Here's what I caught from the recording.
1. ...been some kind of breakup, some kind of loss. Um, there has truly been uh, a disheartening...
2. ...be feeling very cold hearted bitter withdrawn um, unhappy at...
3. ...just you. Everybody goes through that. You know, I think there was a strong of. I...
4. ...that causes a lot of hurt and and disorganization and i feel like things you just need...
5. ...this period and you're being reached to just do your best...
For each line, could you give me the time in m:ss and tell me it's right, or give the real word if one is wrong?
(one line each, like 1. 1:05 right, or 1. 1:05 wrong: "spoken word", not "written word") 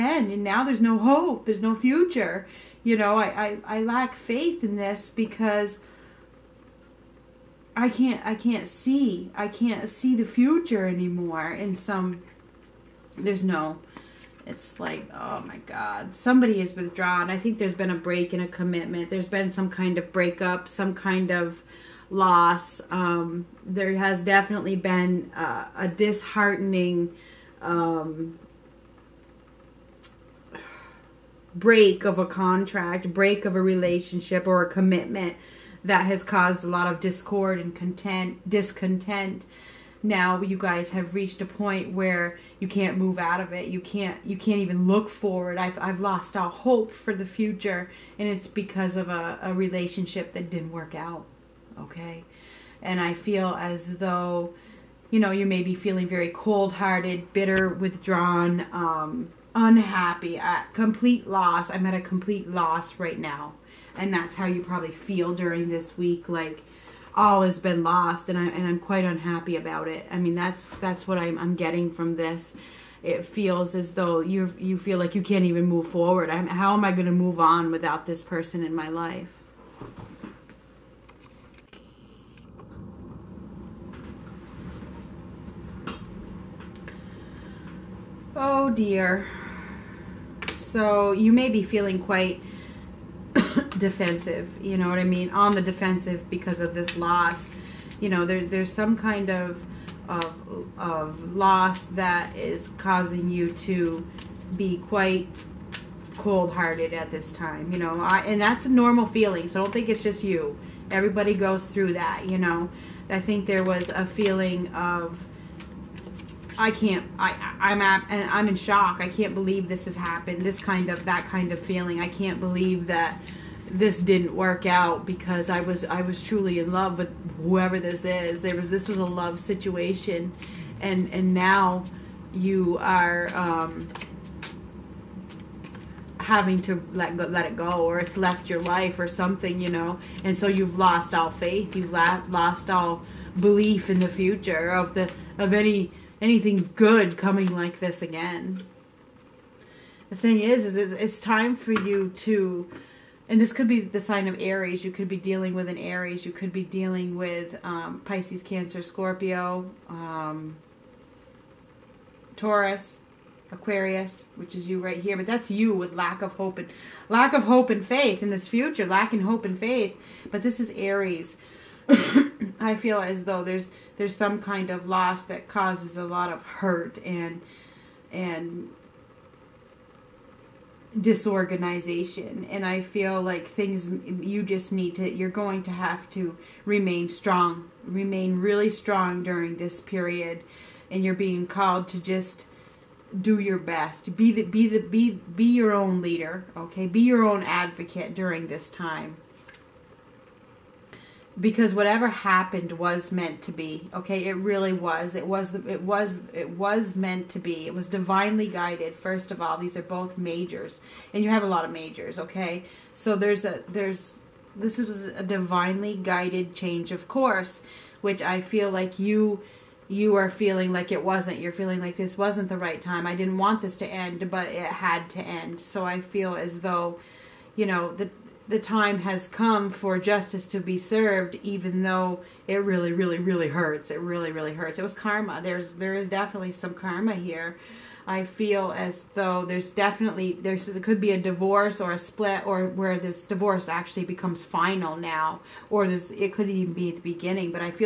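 1. 0:19 wrong: "definitely", not "truly"
2. 0:55 right
3. 1:50 wrong: "feeling", not "strong"
4. 2:55 right
5. 3:09 wrong: "called", not "reached".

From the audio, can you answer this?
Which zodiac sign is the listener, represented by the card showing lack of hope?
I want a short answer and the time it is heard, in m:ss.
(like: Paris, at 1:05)
Aquarius, at 2:43.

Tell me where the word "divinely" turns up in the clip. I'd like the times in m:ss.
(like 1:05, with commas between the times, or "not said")
3:27, 3:35.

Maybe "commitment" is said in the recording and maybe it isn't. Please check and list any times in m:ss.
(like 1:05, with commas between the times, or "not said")
0:18, 0:34.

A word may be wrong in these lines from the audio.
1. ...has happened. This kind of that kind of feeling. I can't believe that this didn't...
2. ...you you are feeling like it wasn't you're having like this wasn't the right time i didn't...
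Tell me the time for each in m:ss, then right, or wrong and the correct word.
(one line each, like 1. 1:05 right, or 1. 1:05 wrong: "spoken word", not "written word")
1. 1:59 right
2. 3:38 wrong: "feeling", not "having".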